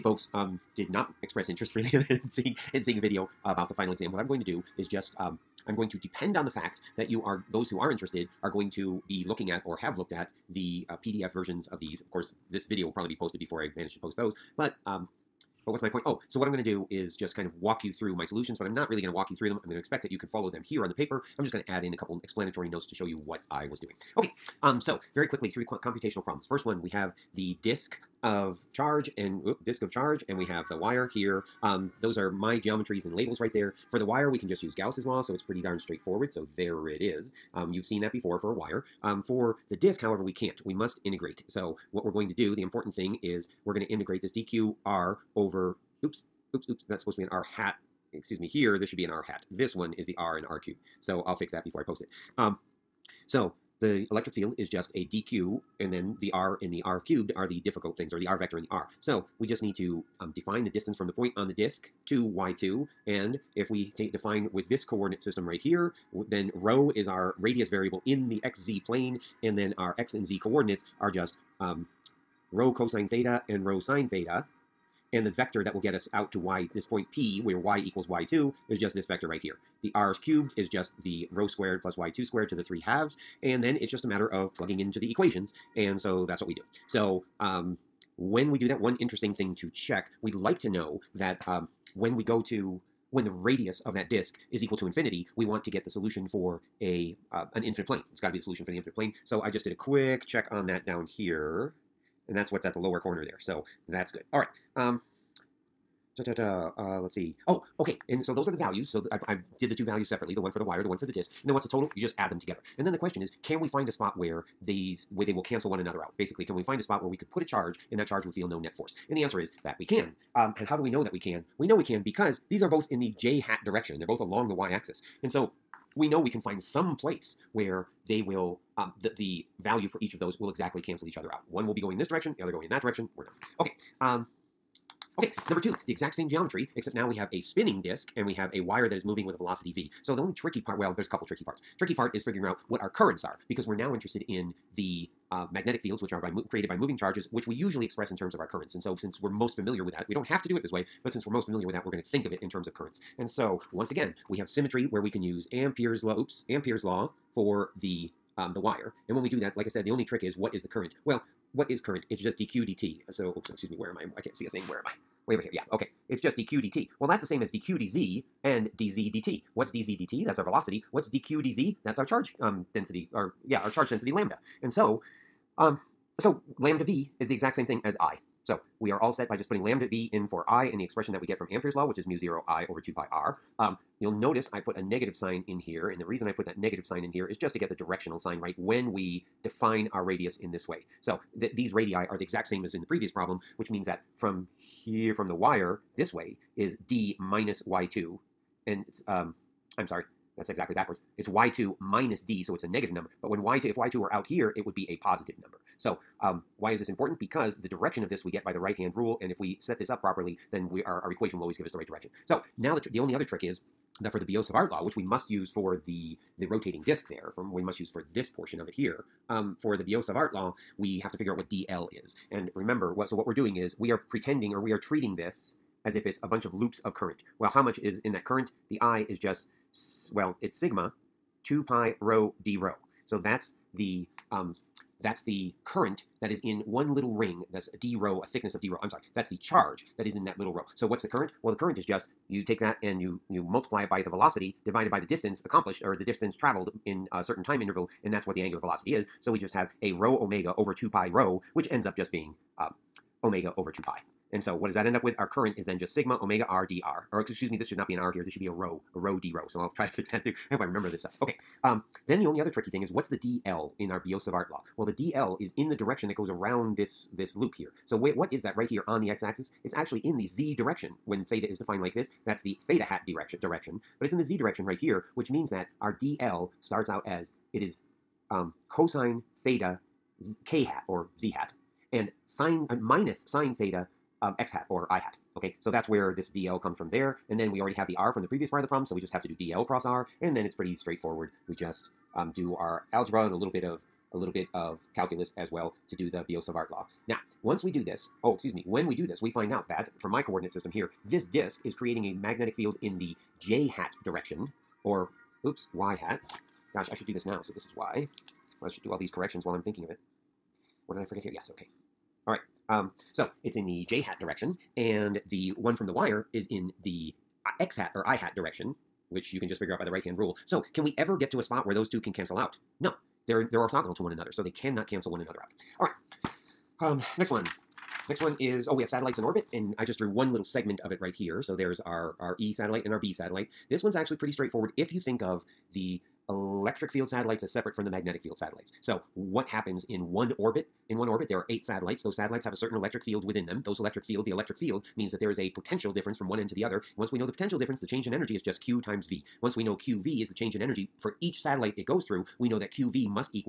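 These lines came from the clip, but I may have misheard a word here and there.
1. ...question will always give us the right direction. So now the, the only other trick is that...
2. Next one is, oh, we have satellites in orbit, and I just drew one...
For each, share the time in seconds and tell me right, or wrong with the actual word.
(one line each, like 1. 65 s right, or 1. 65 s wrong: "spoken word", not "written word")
1. 211 s wrong: "equation", not "question"
2. 328 s right.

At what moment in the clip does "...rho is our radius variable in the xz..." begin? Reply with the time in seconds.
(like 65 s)
66 s.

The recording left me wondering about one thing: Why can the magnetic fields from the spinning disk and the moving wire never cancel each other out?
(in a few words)
they're orthogonal.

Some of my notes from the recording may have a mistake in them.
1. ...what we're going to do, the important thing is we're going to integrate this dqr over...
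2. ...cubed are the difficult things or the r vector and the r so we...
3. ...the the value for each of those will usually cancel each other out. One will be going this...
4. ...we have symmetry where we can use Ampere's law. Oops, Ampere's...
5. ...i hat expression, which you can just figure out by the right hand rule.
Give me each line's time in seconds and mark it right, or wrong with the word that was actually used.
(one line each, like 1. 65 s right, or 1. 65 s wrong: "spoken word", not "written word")
1. 41 s right
2. 57 s right
3. 129 s wrong: "exactly", not "usually"
4. 154 s right
5. 318 s wrong: "direction", not "expression".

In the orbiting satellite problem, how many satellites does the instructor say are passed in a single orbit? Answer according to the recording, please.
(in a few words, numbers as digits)
8.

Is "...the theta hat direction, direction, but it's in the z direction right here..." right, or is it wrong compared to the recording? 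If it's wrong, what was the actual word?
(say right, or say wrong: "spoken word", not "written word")
right.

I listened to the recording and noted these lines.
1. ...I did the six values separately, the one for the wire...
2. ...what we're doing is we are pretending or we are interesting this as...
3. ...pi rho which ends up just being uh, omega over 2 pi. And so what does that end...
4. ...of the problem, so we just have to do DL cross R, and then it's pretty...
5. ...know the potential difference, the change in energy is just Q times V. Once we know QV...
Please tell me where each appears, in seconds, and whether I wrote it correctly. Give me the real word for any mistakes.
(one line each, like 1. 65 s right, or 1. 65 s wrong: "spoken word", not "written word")
1. 109 s wrong: "two", not "six"
2. 223 s wrong: "treating", not "interesting"
3. 250 s right
4. 288 s right
5. 347 s right.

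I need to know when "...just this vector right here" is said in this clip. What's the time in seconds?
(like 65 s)
78 s.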